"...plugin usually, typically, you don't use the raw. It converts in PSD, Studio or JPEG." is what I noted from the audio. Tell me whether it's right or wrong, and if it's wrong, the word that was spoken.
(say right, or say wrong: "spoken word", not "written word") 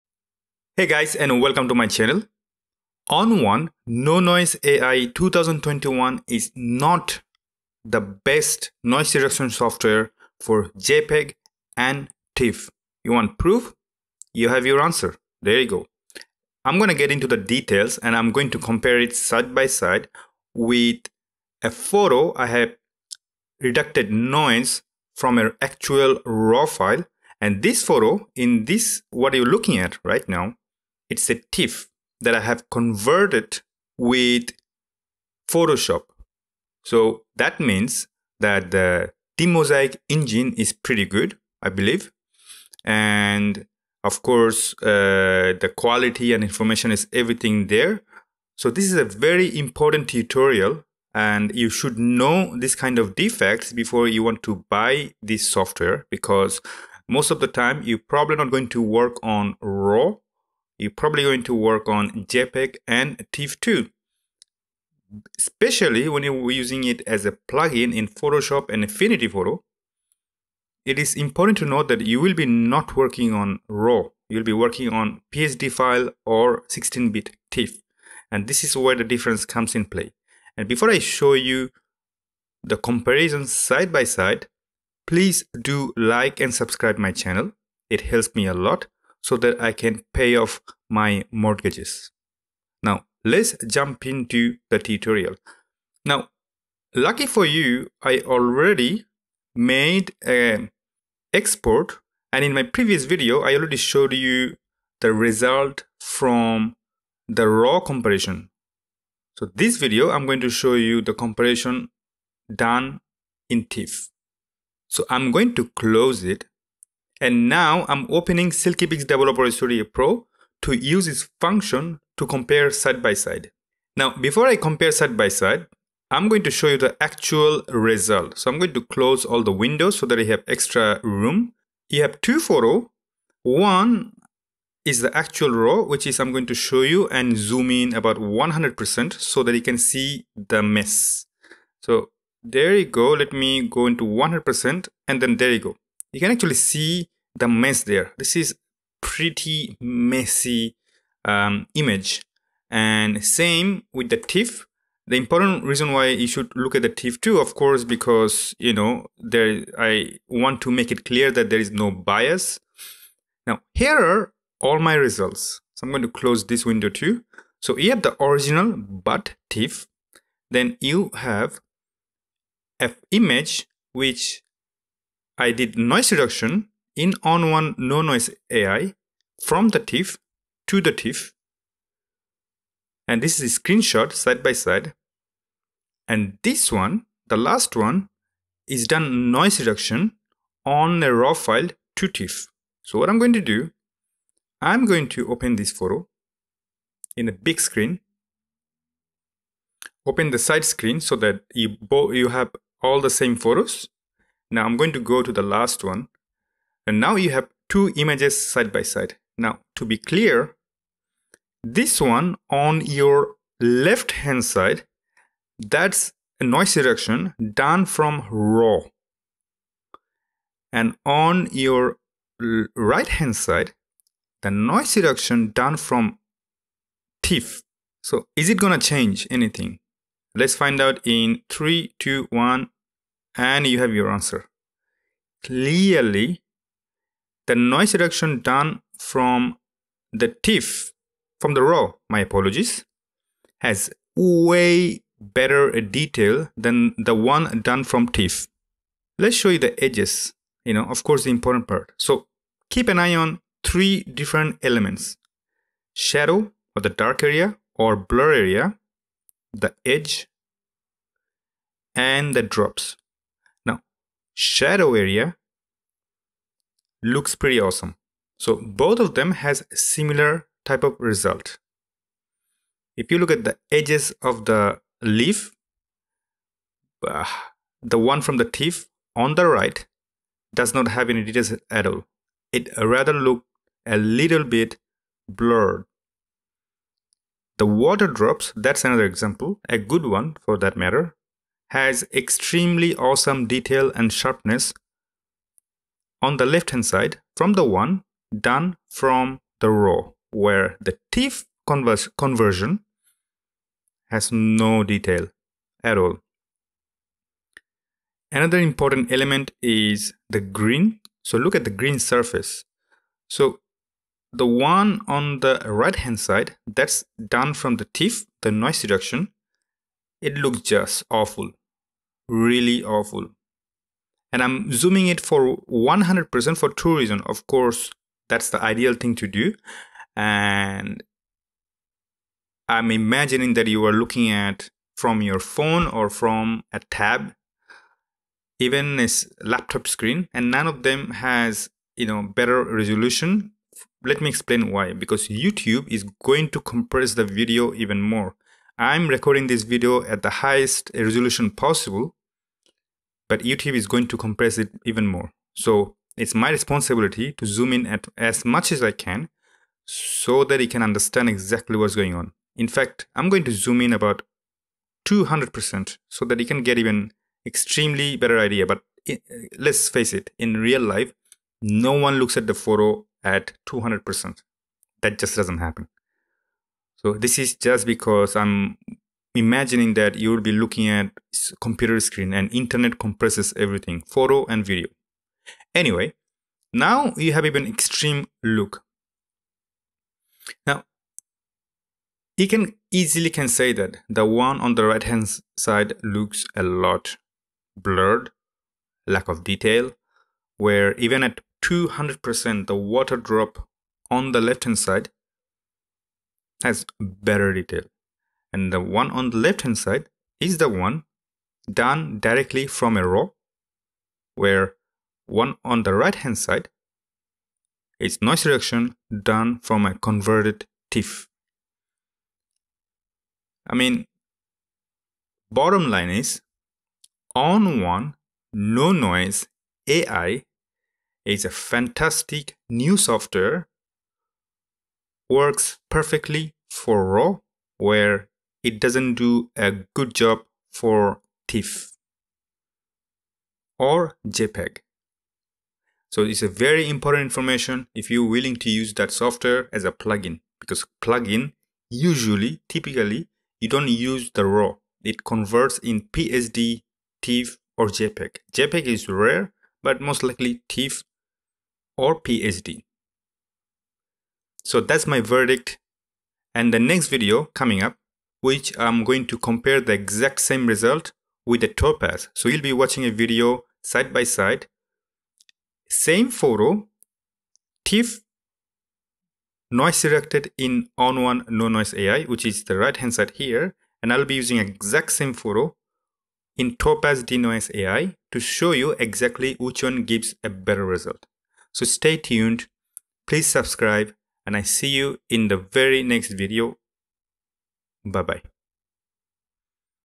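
wrong: "TIFF", not "Studio".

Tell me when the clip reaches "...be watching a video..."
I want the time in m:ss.
7:52.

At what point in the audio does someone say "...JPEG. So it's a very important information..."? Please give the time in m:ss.
7:24.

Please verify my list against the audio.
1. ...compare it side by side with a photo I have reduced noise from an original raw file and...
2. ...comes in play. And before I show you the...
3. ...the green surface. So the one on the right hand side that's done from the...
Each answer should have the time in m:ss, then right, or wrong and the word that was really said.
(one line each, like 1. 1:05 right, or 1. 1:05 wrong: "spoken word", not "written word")
1. 0:18 wrong: "actual", not "original"
2. 1:19 right
3. 5:11 right.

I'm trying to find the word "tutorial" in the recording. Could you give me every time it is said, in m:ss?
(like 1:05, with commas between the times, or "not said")
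0:50, 1:34.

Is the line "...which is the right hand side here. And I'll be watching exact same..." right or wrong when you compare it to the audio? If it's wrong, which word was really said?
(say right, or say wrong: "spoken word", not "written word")
wrong: "using", not "watching".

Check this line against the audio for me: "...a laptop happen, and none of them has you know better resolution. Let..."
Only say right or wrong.
wrong.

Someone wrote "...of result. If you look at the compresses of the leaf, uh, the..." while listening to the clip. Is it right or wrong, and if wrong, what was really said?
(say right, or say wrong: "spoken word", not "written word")
wrong: "edges", not "compresses".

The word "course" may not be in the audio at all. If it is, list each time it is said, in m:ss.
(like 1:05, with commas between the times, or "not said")
0:44, 2:37, 4:11, 5:27.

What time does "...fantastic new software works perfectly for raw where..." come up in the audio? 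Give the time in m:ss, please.
7:11.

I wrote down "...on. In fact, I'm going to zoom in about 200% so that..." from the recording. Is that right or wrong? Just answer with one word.
right.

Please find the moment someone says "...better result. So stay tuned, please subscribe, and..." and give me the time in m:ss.
8:10.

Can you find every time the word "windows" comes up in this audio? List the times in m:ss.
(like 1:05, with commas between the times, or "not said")
2:09, 2:46.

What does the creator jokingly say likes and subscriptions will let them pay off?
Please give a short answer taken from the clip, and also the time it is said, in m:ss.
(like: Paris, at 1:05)
mortgages, at 1:31.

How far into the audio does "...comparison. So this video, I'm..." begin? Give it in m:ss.
1:47.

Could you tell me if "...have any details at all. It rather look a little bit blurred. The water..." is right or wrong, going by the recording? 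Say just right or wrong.
right.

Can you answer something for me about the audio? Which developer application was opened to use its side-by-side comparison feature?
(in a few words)
SilkyPix Developer Studio Pro.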